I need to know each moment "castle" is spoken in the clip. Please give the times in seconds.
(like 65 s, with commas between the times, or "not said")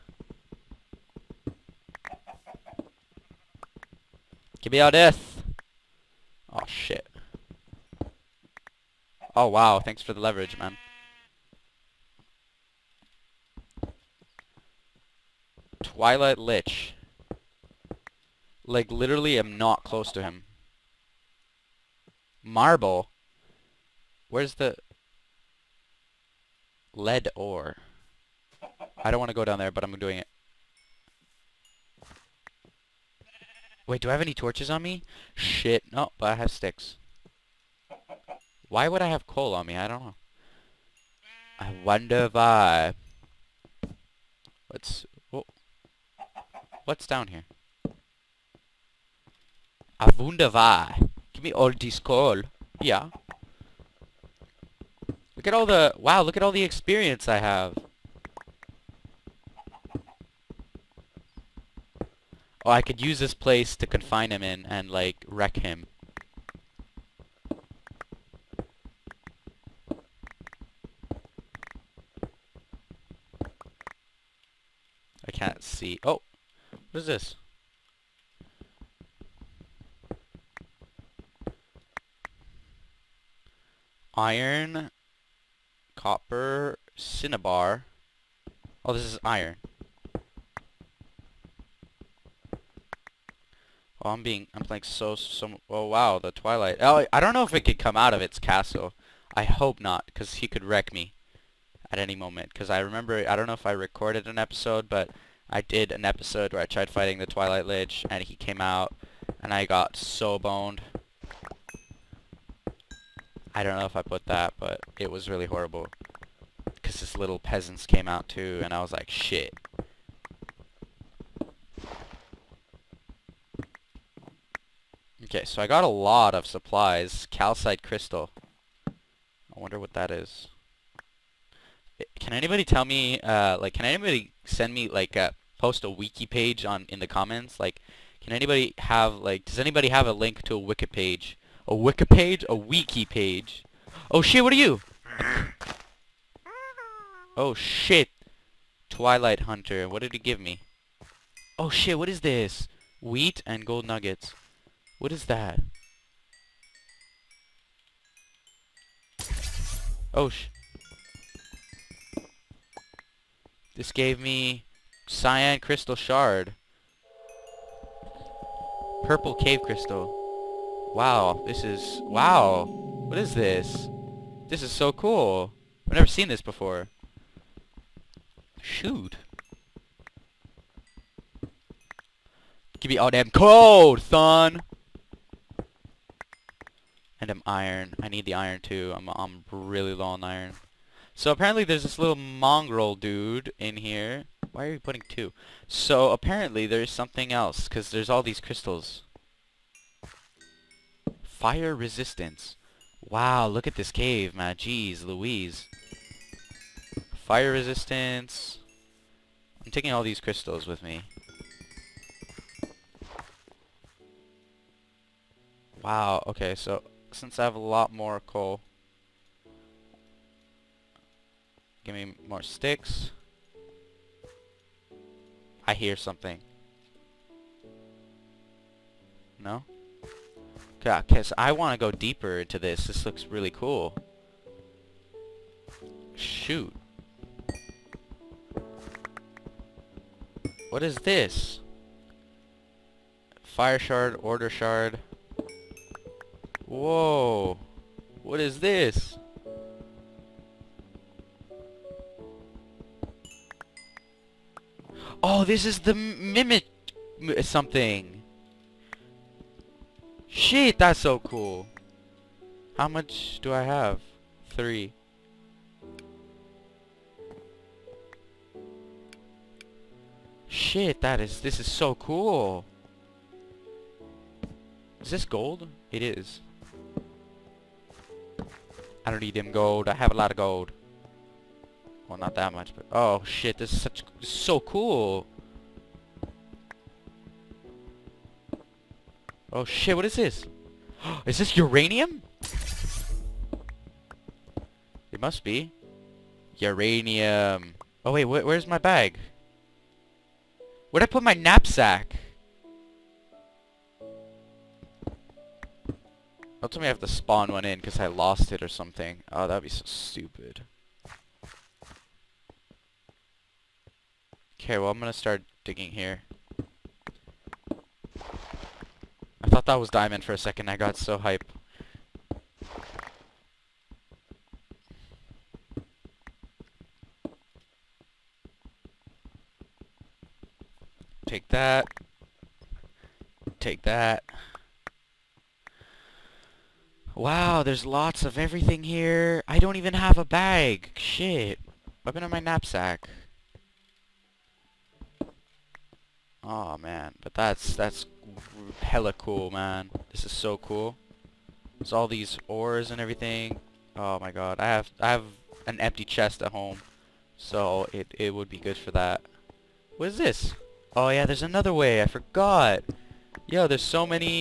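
98 s.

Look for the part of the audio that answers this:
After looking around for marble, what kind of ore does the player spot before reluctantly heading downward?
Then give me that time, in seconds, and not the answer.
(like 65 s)
26 s.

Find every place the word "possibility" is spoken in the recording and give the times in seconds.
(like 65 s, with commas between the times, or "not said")
not said.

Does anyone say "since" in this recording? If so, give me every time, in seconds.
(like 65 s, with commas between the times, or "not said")
217 s.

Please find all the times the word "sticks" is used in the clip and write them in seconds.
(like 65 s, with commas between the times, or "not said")
36 s, 222 s.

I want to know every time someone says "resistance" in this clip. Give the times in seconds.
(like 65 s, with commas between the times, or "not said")
201 s, 207 s.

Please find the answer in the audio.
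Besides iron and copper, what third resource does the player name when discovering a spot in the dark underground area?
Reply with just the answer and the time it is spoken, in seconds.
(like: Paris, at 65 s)
cinnabar, at 86 s.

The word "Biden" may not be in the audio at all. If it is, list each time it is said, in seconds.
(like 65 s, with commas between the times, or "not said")
not said.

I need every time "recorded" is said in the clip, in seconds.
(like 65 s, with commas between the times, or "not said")
103 s.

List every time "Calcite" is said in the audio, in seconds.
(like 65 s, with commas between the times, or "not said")
127 s.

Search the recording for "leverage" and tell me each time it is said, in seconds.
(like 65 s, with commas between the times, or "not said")
10 s.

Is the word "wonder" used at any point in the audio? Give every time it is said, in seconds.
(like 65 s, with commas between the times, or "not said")
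41 s, 50 s, 129 s.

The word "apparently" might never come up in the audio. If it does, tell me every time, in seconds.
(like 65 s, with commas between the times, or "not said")
191 s, 196 s.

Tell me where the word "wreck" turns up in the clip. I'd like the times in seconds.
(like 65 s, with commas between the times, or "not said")
65 s, 100 s.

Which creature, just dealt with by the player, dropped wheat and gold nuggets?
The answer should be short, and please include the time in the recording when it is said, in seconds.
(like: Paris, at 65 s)
Twilight Hunter, at 148 s.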